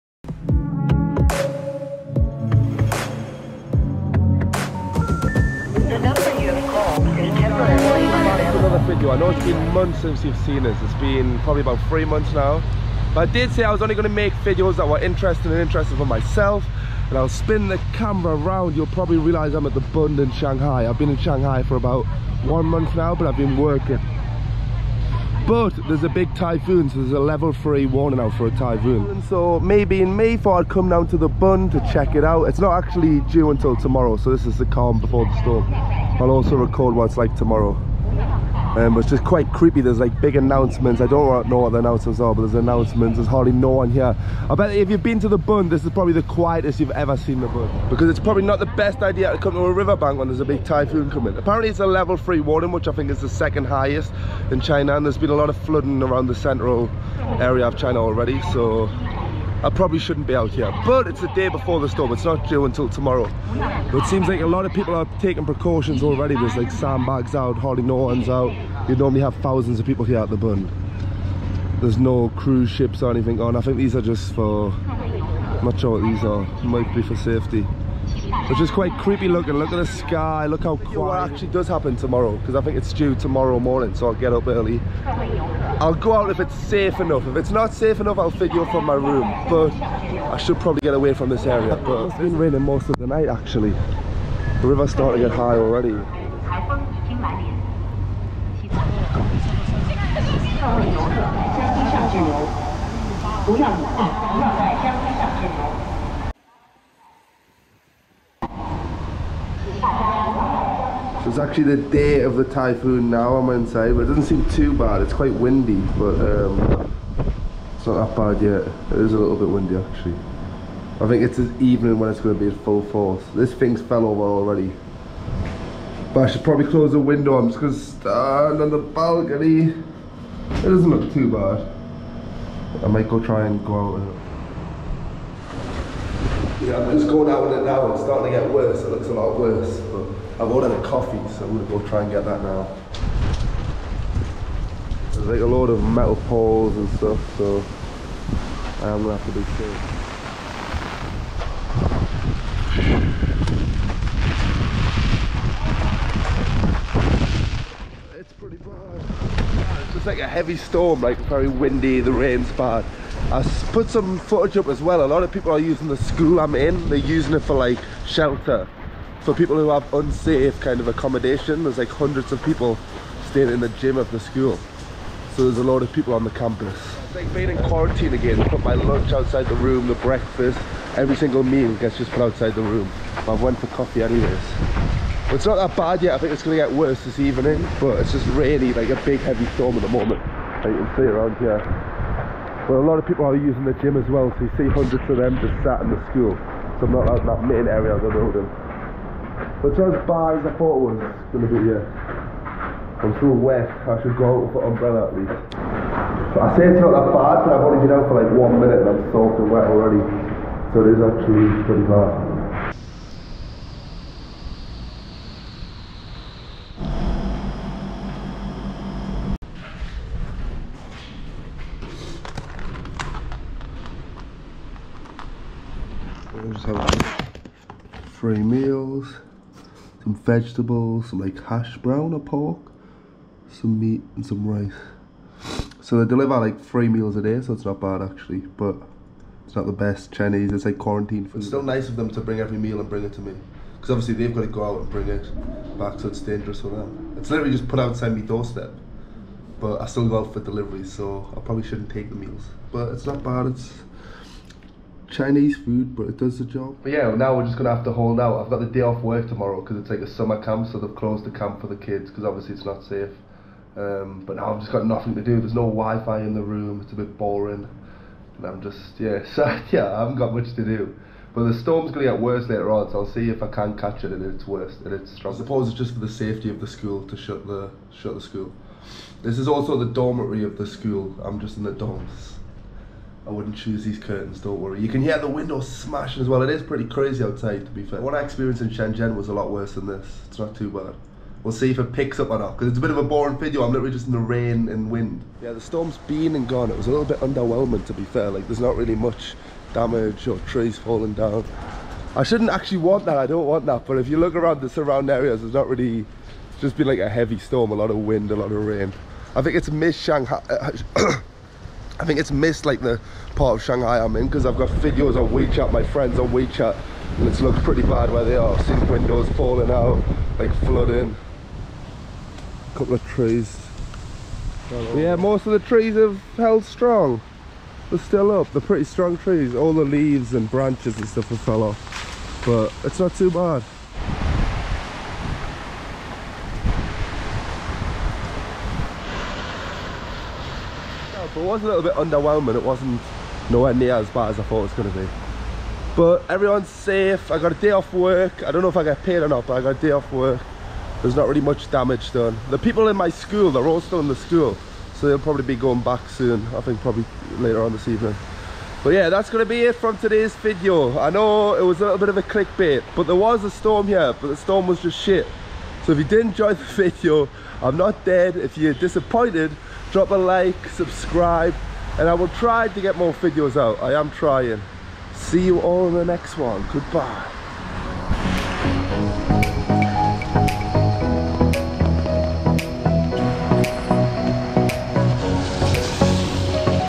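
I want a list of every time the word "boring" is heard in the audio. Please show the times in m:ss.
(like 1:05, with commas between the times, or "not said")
4:27, 4:53.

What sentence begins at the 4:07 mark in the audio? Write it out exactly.
It's literally just put outside my doorstep.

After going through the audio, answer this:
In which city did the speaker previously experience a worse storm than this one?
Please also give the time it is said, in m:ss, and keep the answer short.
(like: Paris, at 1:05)
Shenzhen, at 4:48.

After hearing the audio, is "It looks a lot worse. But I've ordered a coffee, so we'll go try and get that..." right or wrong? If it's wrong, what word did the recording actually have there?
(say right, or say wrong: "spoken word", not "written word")
right.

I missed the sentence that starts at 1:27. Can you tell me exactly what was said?
If it's not safe enough, I'll figure from my room, but I should probably get away from this area.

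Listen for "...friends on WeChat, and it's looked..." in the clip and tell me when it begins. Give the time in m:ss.
5:15.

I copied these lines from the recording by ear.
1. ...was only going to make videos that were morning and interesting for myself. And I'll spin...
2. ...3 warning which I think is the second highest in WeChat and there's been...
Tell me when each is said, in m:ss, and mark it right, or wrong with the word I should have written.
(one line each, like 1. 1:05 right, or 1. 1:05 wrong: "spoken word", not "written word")
1. 0:13 wrong: "interesting", not "morning"
2. 0:52 wrong: "China", not "WeChat".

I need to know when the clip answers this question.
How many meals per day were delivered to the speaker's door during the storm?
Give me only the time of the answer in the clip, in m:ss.
3:56.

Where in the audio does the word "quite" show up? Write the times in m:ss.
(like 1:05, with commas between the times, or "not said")
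0:39, 1:18, 1:55.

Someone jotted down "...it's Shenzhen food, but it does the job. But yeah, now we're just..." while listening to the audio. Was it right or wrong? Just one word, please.
wrong.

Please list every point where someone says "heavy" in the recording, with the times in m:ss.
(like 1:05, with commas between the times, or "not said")
2:40, 3:09, 5:07.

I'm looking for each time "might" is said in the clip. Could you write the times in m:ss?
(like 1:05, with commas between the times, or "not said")
1:16, 2:12.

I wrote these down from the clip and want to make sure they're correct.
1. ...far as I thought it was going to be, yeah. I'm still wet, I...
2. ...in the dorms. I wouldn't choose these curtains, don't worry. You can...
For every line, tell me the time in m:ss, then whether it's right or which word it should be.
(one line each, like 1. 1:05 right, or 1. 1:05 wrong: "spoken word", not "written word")
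1. 3:20 right
2. 4:41 right.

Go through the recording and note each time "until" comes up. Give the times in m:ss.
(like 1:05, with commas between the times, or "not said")
0:33, 1:02.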